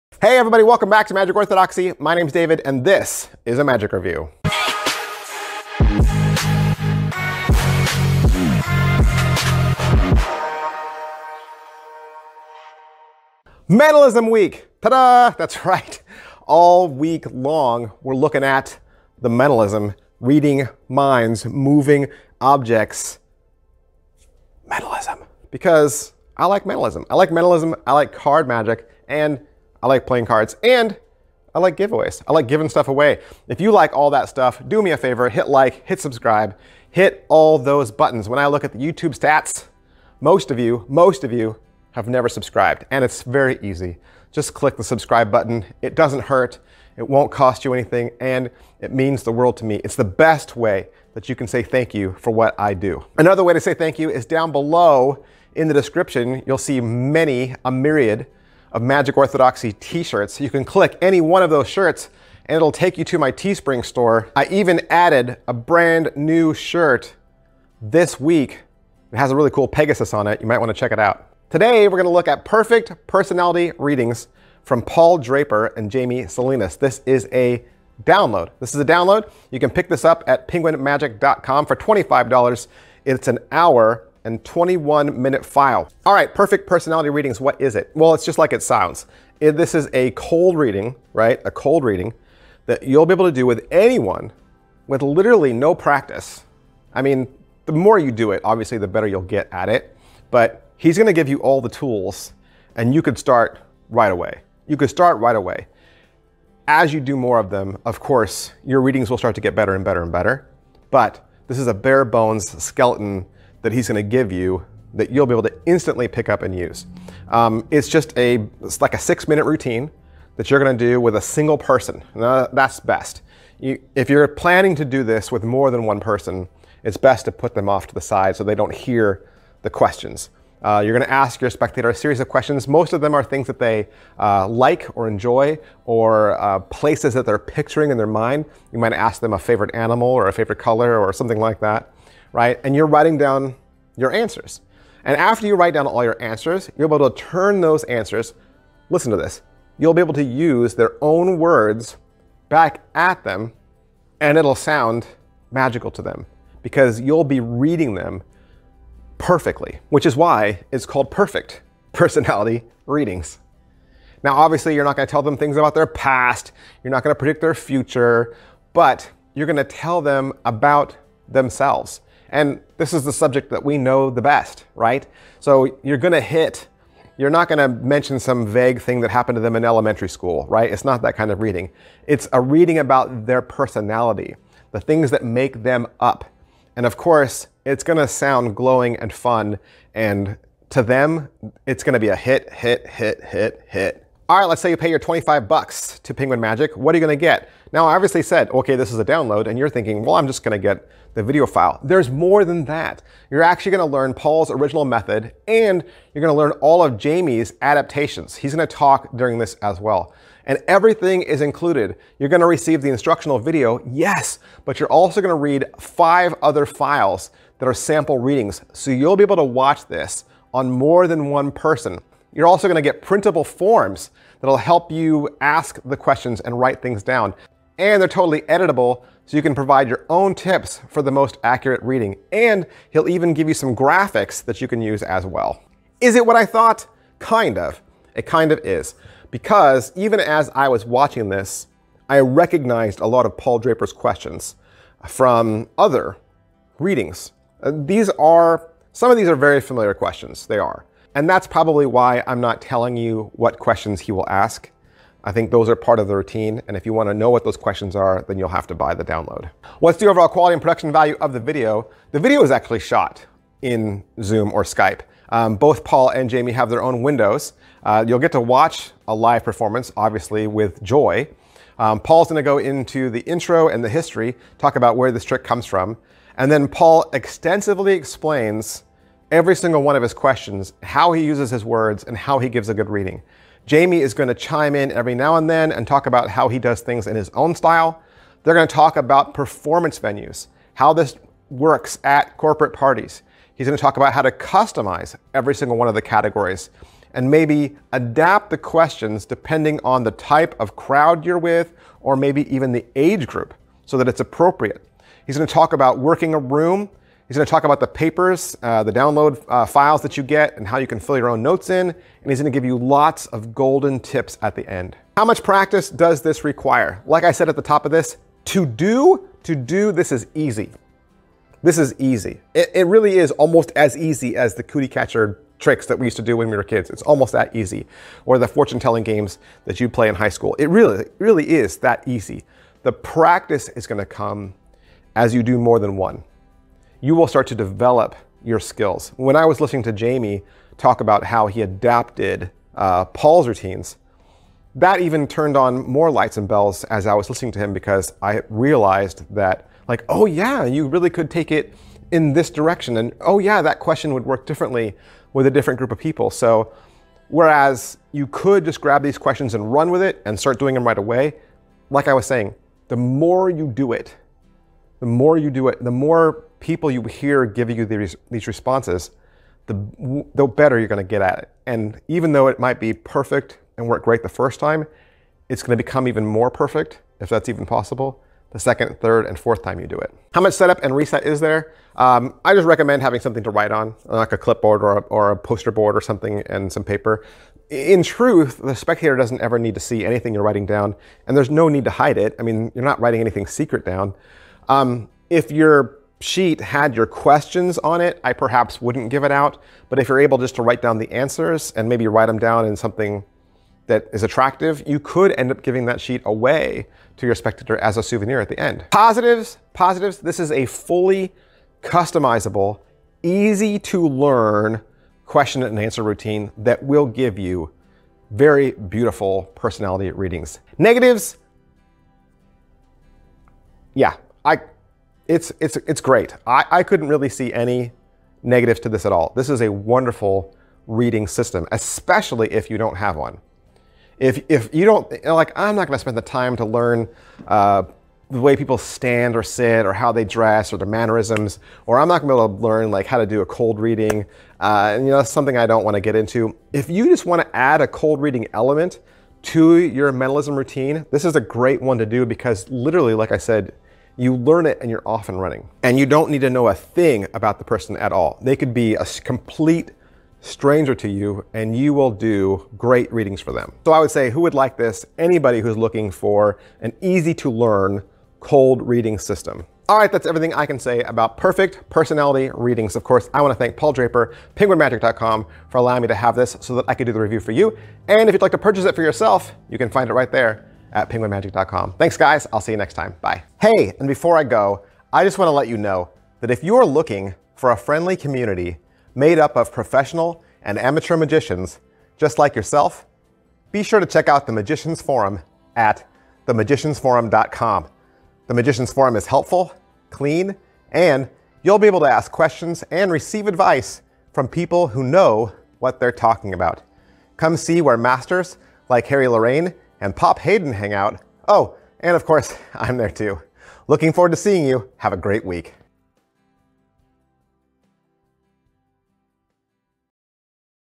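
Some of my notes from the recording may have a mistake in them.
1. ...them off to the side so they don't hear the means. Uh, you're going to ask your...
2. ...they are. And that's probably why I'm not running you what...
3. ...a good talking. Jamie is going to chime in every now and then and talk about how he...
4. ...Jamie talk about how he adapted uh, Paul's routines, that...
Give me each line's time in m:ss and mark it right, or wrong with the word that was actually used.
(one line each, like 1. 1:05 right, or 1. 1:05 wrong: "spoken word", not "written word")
1. 2:07 wrong: "questions", not "means"
2. 4:10 wrong: "telling", not "running"
3. 4:42 wrong: "reading", not "talking"
4. 5:39 right.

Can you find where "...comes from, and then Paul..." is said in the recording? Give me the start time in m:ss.
4:35.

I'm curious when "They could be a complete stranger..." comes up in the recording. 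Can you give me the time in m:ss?
7:38.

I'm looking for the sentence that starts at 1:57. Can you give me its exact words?
Um, it's just a, it's like a six minute routine that you're going to do with a single person.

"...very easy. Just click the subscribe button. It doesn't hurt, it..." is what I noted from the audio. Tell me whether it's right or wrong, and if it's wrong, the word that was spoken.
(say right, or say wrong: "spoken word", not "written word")
right.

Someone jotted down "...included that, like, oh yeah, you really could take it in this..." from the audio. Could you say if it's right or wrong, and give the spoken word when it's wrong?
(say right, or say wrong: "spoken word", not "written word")
wrong: "realized", not "included".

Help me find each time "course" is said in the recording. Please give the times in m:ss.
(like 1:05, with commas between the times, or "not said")
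1:47, 3:06, 7:53, 8:32.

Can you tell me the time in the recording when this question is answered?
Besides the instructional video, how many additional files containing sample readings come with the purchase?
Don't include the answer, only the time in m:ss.
3:35.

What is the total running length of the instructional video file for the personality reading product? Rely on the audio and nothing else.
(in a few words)
1 hour 21 minutes.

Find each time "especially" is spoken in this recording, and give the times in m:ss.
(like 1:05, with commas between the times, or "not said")
7:11.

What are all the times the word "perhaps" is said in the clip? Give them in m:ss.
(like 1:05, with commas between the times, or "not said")
6:38.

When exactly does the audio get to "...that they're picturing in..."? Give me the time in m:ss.
2:17.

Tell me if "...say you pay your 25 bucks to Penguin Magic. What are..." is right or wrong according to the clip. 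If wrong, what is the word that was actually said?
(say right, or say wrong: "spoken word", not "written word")
right.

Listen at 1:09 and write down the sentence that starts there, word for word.
It has a really cool Pegasus on it.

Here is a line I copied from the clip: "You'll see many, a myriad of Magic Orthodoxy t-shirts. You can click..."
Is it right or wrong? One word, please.
right.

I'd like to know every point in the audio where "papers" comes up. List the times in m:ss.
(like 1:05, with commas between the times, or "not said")
5:07, 6:26.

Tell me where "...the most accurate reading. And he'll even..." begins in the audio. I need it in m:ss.
3:51.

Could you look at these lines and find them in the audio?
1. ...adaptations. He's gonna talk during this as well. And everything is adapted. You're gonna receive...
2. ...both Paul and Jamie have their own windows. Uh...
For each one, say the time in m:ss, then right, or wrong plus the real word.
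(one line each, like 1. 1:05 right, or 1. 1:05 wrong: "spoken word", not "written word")
1. 3:27 wrong: "included", not "adapted"
2. 4:25 right.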